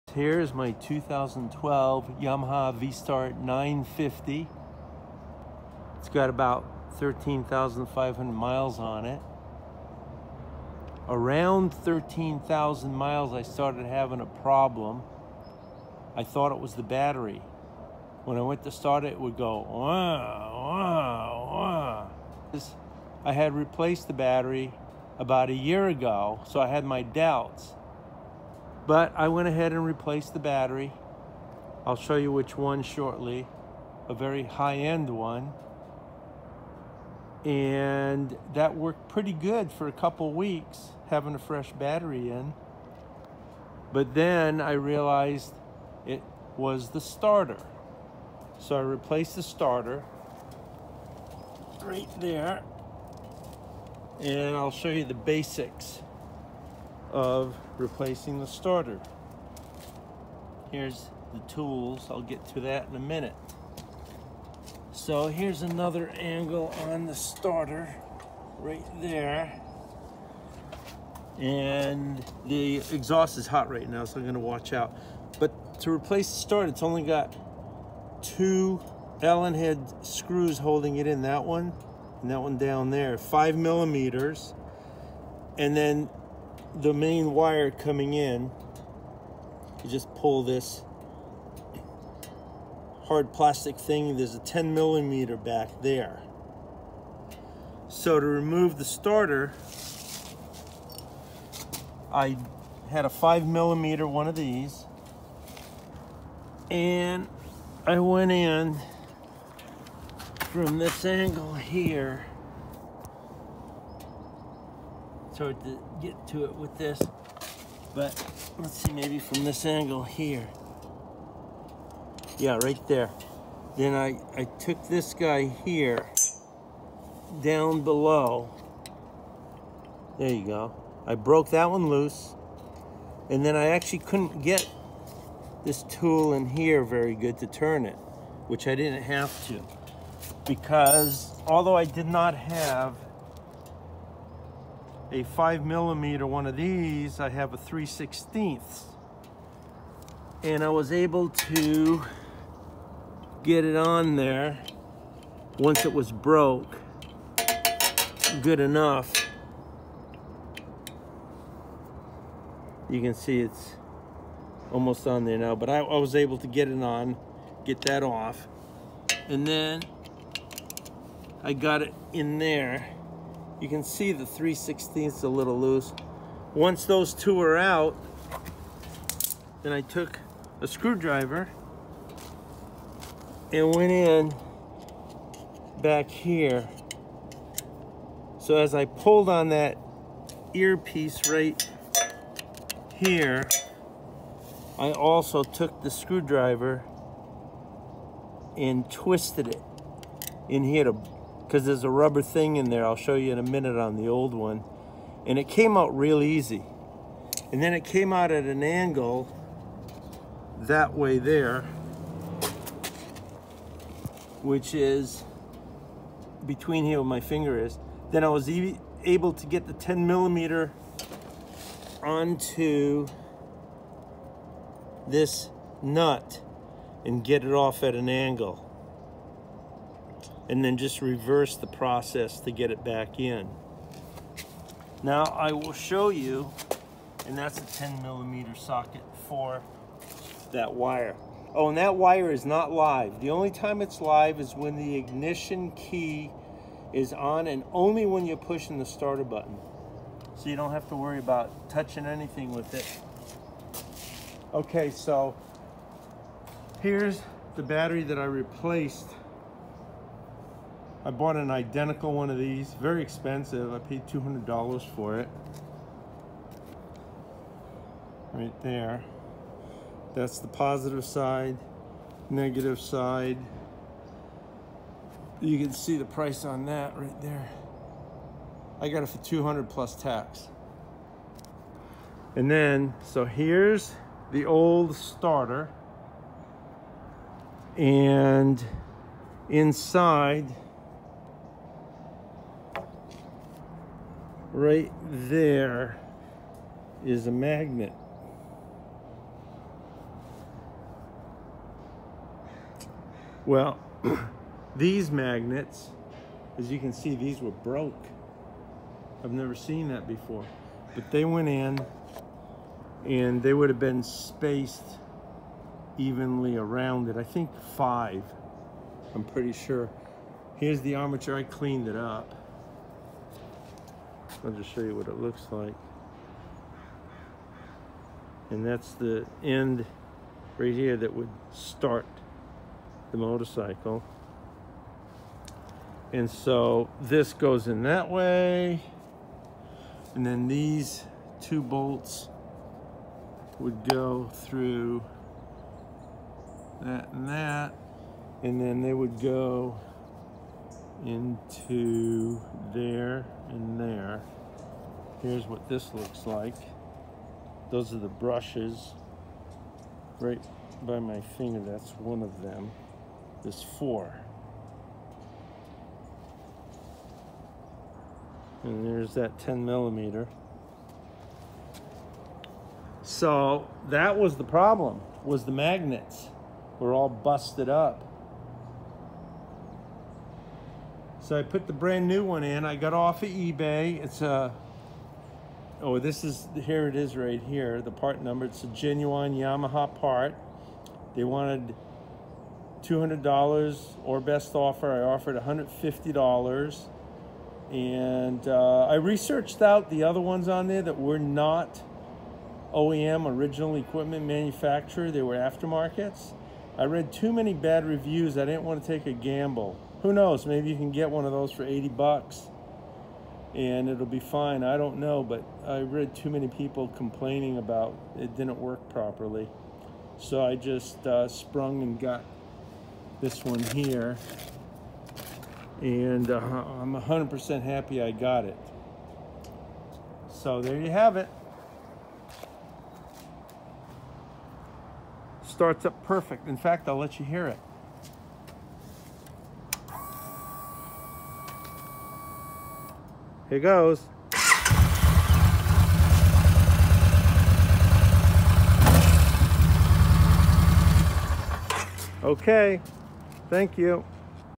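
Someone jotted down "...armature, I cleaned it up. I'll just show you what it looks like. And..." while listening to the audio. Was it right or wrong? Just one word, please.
right.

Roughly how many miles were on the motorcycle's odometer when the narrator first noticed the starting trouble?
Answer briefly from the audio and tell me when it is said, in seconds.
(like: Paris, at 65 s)
13,000, at 11 s.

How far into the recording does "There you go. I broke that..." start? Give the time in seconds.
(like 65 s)
130 s.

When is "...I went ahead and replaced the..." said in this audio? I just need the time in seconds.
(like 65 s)
29 s.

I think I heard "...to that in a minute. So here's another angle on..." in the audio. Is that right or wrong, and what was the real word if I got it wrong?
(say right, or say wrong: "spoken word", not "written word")
right.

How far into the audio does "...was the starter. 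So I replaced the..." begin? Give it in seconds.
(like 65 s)
46 s.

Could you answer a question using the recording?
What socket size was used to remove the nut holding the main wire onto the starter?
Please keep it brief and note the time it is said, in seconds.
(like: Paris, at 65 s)
10 millimeter, at 237 s.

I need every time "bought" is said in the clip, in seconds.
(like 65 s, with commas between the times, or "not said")
261 s.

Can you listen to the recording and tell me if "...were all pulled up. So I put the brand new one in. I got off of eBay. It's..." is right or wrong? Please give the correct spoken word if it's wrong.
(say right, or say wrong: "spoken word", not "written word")
wrong: "busted", not "pulled".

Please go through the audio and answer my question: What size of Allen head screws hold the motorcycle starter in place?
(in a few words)
5 millimeters.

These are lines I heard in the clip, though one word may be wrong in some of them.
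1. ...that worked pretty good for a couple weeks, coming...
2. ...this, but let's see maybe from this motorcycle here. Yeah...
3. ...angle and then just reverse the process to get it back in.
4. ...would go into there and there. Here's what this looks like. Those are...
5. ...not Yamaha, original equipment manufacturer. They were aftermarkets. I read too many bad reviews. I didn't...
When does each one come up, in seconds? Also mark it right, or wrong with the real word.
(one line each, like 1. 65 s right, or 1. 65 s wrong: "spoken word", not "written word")
1. 38 s wrong: "having", not "coming"
2. 116 s wrong: "angle", not "motorcycle"
3. 228 s right
4. 348 s right
5. 401 s wrong: "OEM", not "Yamaha".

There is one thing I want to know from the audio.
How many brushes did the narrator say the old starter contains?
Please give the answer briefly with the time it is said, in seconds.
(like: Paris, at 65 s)
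4, at 363 s.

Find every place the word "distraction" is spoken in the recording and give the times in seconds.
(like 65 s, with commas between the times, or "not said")
not said.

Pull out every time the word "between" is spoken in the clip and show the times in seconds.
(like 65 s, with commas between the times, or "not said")
216 s.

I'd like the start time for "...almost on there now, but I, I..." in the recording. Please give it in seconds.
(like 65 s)
164 s.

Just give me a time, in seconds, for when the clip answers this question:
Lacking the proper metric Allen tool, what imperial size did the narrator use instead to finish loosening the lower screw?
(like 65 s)
147 s.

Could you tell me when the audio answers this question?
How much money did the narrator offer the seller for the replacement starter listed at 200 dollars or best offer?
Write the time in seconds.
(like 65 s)
395 s.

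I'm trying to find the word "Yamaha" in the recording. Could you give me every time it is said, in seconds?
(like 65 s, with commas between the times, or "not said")
2 s, 389 s.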